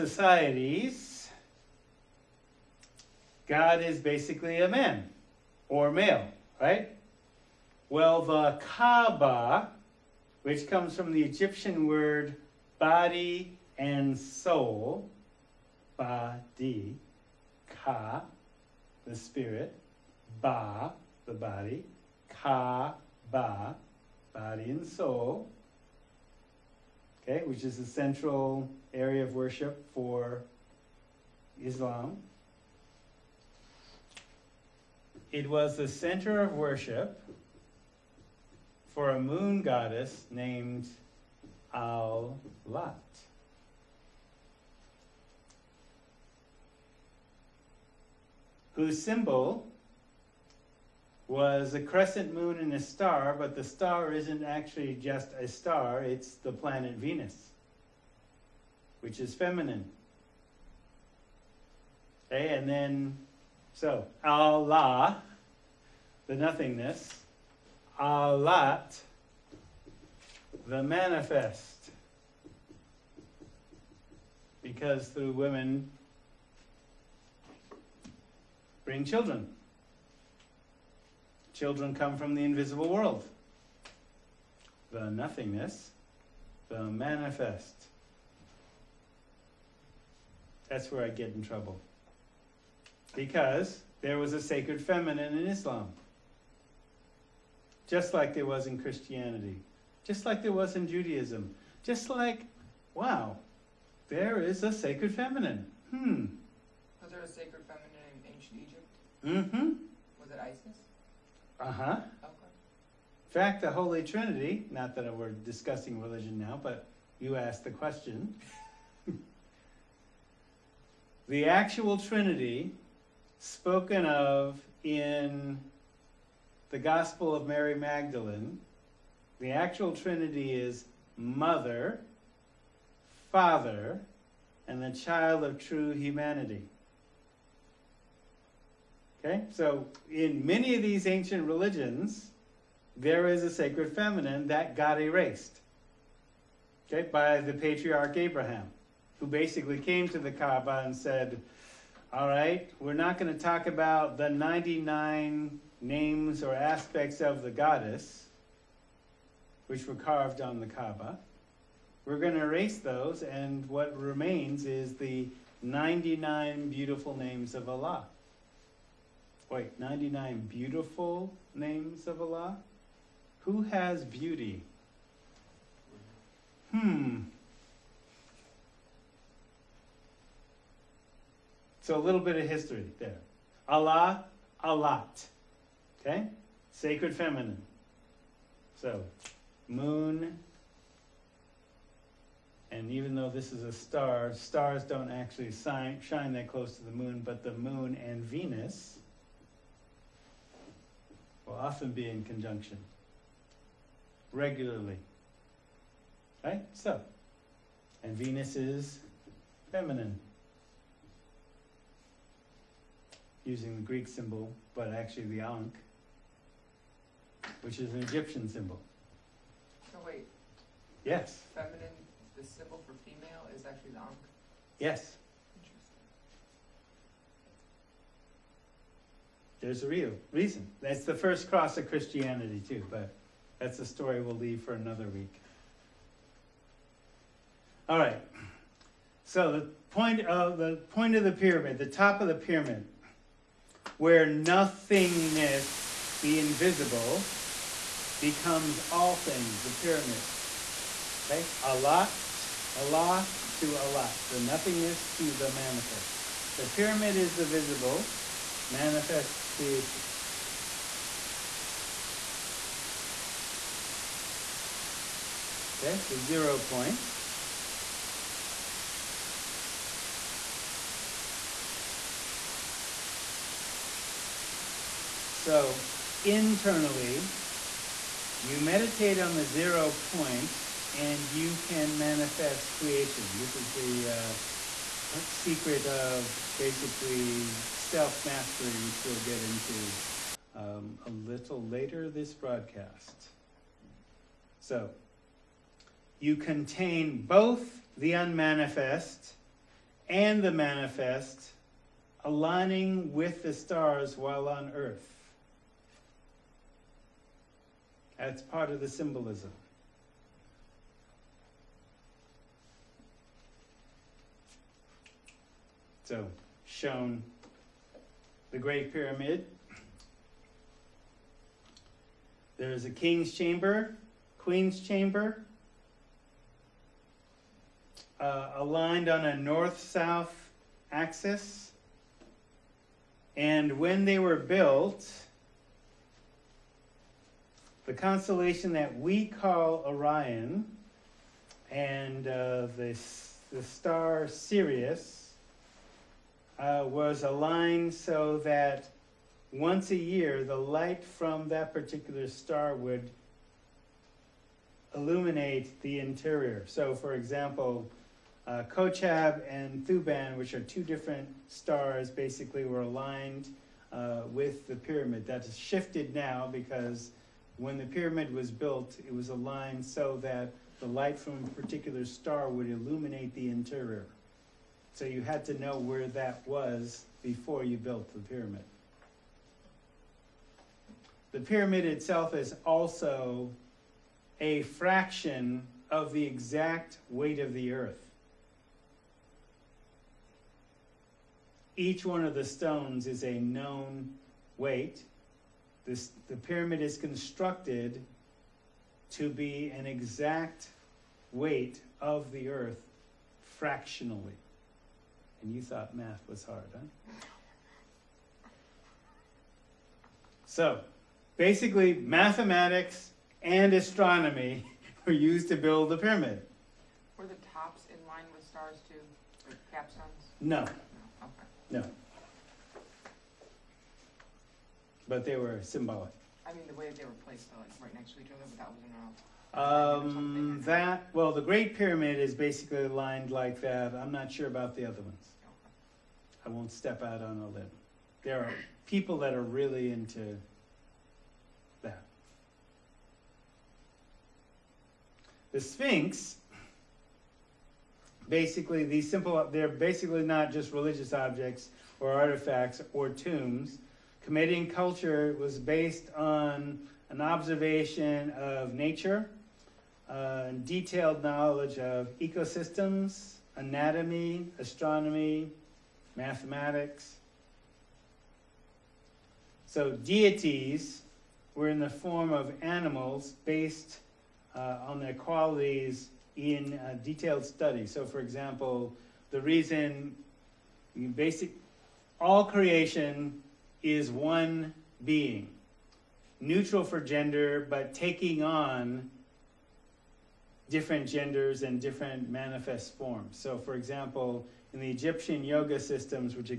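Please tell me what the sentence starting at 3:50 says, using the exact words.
That's the first cross of Christianity, too, but that's a story we'll leave for another week.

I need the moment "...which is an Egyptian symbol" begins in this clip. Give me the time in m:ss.
3:37.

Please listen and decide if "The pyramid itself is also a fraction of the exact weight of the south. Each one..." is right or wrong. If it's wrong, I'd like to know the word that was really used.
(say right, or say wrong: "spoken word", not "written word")
wrong: "earth", not "south".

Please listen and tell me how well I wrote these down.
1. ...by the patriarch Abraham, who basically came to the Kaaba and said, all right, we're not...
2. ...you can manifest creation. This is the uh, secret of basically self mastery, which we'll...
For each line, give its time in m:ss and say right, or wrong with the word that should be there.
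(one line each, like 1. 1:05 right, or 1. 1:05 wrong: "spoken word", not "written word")
1. 2:27 right
2. 4:41 right.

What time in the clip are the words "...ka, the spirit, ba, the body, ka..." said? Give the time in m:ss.
0:17.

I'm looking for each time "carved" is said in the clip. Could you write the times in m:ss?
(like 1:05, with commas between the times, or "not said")
2:39.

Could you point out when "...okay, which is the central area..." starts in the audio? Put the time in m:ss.
0:27.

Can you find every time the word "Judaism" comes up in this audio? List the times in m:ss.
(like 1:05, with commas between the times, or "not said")
1:40.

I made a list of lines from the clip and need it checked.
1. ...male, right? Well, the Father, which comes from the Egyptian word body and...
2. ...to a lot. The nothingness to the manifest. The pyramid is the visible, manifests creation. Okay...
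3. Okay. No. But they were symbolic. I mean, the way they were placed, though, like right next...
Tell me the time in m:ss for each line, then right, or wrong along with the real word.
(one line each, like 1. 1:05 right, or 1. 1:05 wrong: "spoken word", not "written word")
1. 0:05 wrong: "Kaaba", not "Father"
2. 4:13 right
3. 7:01 right.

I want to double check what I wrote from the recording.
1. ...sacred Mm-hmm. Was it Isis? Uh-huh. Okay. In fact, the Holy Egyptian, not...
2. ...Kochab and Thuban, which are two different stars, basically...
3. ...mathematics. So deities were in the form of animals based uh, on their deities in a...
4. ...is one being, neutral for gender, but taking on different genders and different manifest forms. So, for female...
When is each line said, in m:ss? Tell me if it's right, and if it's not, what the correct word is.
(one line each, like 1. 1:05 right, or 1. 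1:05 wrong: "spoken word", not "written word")
1. 1:47 wrong: "Trinity", not "Egyptian"
2. 5:58 right
3. 7:46 wrong: "qualities", not "deities"
4. 8:03 wrong: "example", not "female".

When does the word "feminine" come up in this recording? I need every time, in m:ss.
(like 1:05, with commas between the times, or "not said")
0:59, 1:34, 1:45, 2:23, 3:07, 3:29, 3:41.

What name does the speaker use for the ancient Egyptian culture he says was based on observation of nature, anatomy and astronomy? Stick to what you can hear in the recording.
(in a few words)
Kemetian.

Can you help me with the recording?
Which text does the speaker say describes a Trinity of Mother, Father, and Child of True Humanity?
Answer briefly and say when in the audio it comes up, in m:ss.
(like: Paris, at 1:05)
Gospel of Mary Magdalene, at 2:06.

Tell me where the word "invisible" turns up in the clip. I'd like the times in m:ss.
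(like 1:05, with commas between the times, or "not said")
1:22, 4:06.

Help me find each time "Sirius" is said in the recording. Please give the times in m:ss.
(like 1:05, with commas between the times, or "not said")
5:44.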